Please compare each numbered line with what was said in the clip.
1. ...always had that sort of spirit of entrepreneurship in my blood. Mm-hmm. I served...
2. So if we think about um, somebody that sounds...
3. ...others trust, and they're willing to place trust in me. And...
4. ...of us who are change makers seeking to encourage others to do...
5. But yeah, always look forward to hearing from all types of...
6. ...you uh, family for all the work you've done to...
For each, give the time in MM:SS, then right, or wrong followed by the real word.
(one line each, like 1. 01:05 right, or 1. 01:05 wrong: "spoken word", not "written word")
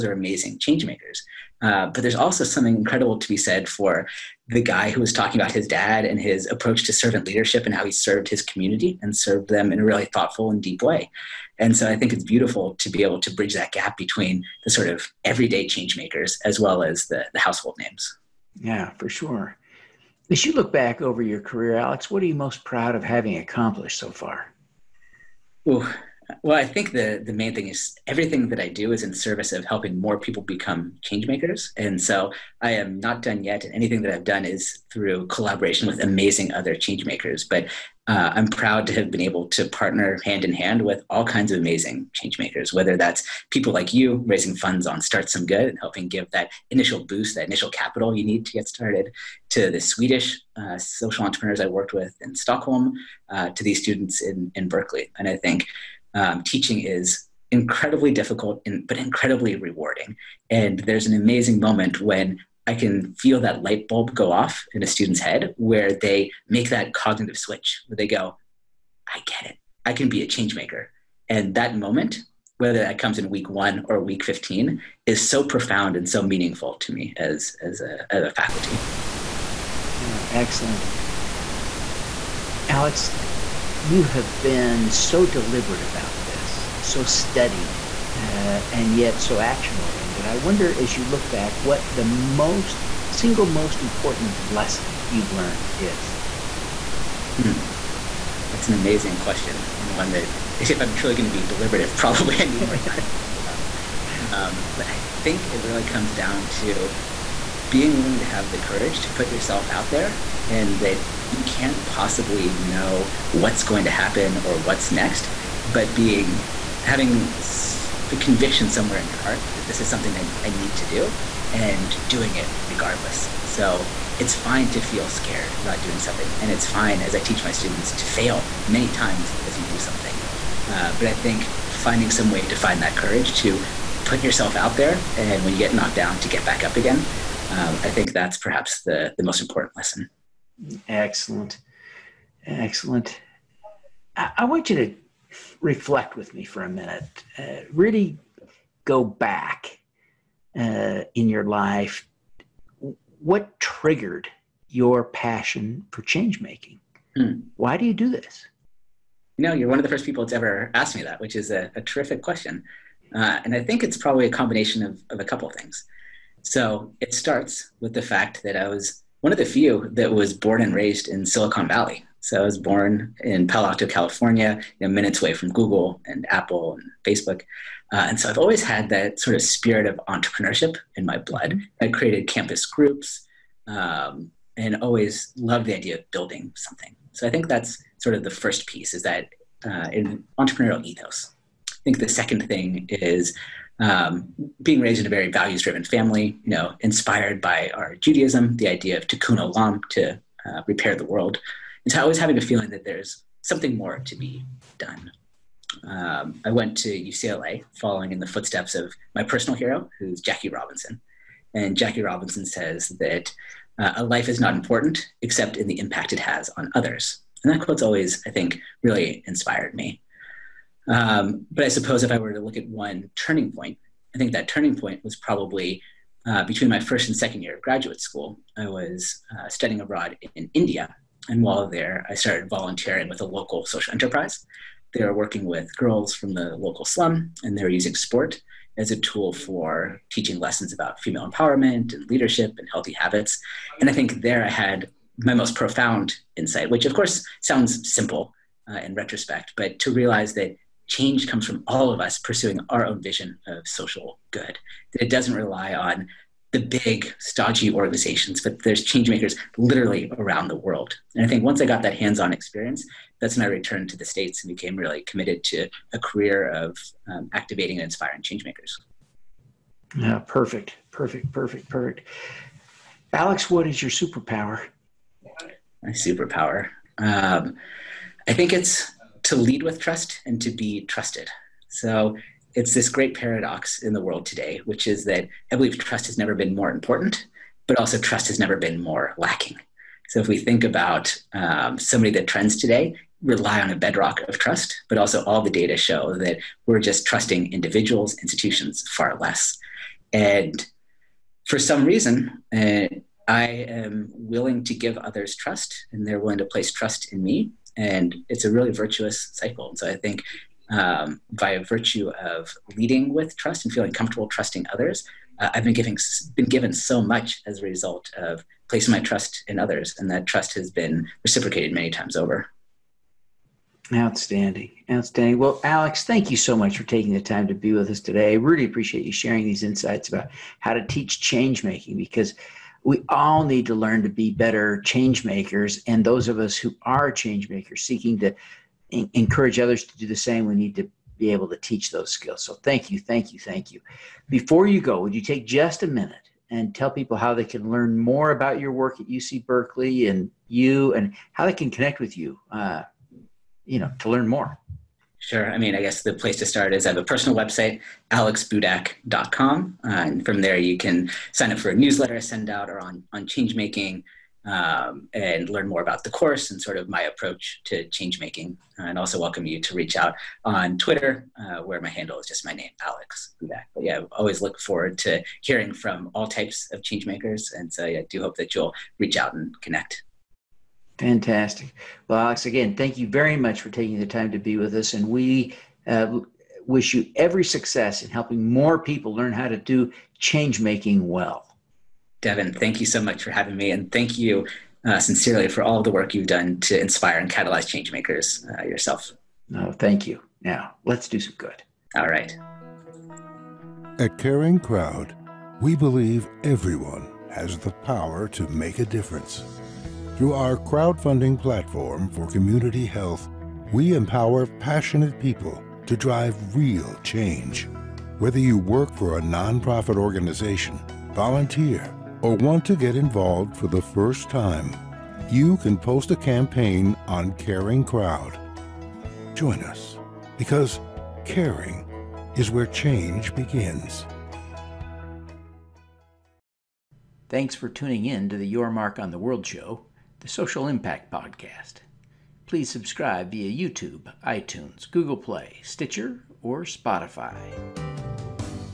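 1. 02:58 wrong: "created", not "served"
2. 04:50 wrong: "trends", not "sounds"
3. 05:04 right
4. 05:36 right
5. 06:13 right
6. 06:34 wrong: "sincerely", not "family".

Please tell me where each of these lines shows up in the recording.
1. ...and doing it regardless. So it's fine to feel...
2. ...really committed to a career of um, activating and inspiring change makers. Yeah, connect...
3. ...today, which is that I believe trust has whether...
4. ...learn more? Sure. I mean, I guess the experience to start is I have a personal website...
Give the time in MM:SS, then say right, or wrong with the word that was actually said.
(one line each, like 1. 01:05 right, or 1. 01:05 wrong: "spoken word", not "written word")
1. 02:01 right
2. 04:24 wrong: "perfect", not "connect"
3. 04:44 wrong: "never", not "whether"
4. 05:54 wrong: "place", not "experience".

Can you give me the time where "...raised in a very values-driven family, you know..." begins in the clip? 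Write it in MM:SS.
03:14.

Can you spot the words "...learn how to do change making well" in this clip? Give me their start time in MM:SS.
06:29.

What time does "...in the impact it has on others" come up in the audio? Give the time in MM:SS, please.
03:35.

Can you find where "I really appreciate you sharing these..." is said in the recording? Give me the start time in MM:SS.
05:28.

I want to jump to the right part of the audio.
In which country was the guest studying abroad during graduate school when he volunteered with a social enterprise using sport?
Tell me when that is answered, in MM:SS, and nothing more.
03:50.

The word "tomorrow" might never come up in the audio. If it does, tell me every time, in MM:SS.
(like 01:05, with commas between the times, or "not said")
not said.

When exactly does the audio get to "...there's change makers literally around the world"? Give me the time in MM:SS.
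04:18.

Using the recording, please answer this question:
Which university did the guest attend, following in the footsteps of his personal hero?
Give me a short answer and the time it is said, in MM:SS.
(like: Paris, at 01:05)
UCLA, at 03:26.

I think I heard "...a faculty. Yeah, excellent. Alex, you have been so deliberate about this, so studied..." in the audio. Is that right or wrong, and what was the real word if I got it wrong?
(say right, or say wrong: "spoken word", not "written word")
right.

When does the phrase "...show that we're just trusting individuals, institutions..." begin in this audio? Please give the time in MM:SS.
04:55.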